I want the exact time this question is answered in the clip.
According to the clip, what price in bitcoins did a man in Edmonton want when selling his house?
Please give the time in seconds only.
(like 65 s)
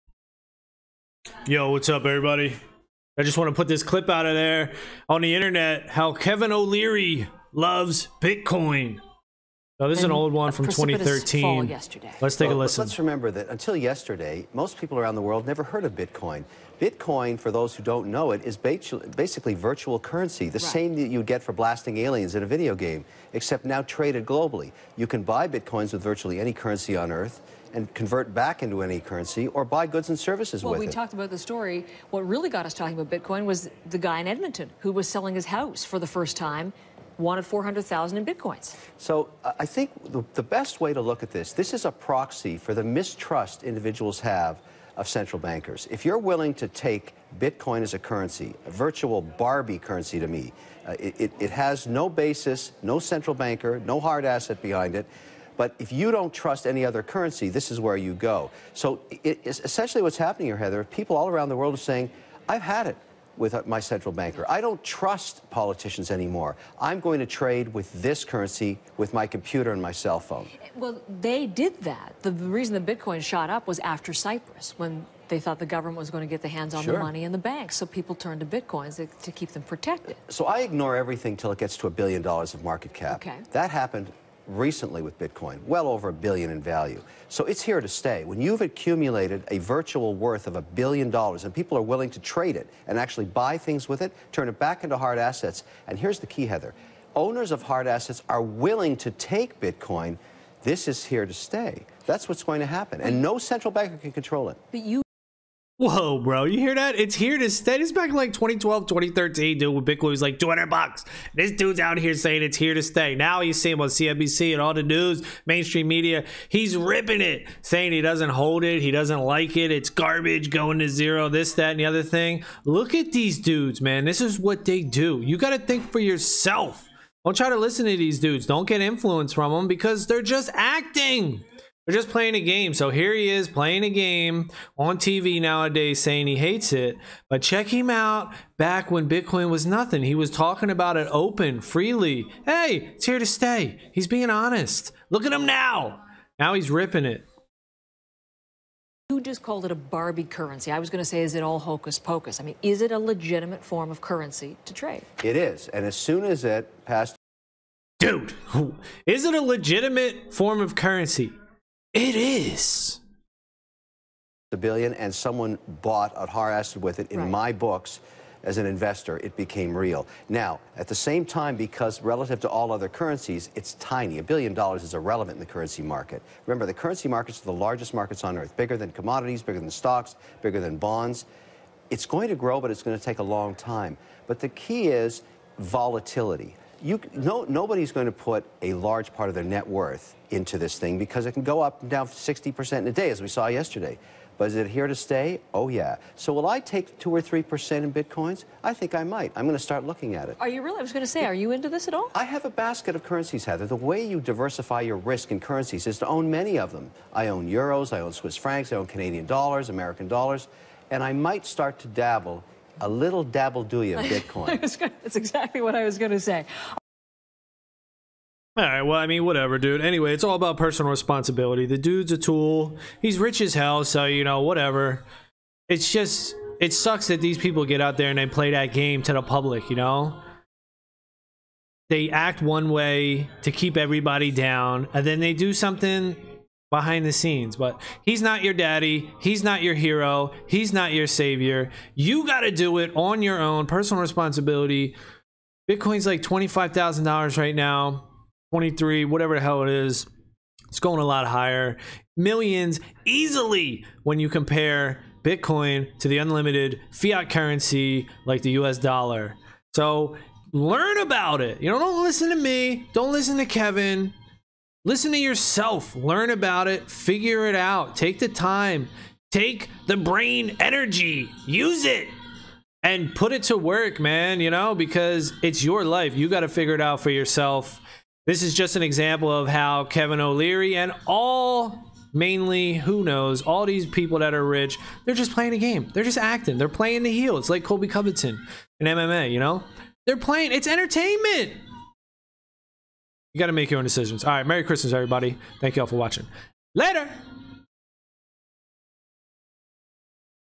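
37 s.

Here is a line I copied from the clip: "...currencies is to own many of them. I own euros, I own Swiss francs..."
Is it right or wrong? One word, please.
right.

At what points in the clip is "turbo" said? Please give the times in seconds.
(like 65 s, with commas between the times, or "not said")
not said.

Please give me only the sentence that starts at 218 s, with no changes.
All right, well, I mean, whatever, dude.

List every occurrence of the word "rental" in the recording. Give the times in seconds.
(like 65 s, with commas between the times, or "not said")
not said.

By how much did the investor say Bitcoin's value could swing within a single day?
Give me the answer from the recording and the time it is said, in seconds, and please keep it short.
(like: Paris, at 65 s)
60%, at 192 s.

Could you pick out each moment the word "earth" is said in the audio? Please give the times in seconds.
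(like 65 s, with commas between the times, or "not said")
27 s, 178 s.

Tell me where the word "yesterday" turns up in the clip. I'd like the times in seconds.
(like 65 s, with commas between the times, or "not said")
13 s, 193 s.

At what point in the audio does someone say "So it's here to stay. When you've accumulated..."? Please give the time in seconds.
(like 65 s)
87 s.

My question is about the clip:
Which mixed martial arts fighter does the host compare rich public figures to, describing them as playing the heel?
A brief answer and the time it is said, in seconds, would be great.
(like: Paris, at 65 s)
Colby Covington, at 287 s.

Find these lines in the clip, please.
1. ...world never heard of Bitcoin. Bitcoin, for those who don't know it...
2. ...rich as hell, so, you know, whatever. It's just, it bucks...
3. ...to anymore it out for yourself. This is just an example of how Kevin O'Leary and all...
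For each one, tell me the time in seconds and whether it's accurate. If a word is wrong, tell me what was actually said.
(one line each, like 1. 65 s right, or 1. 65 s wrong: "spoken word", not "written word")
1. 15 s right
2. 223 s wrong: "sucks", not "bucks"
3. 276 s wrong: "figure", not "anymore".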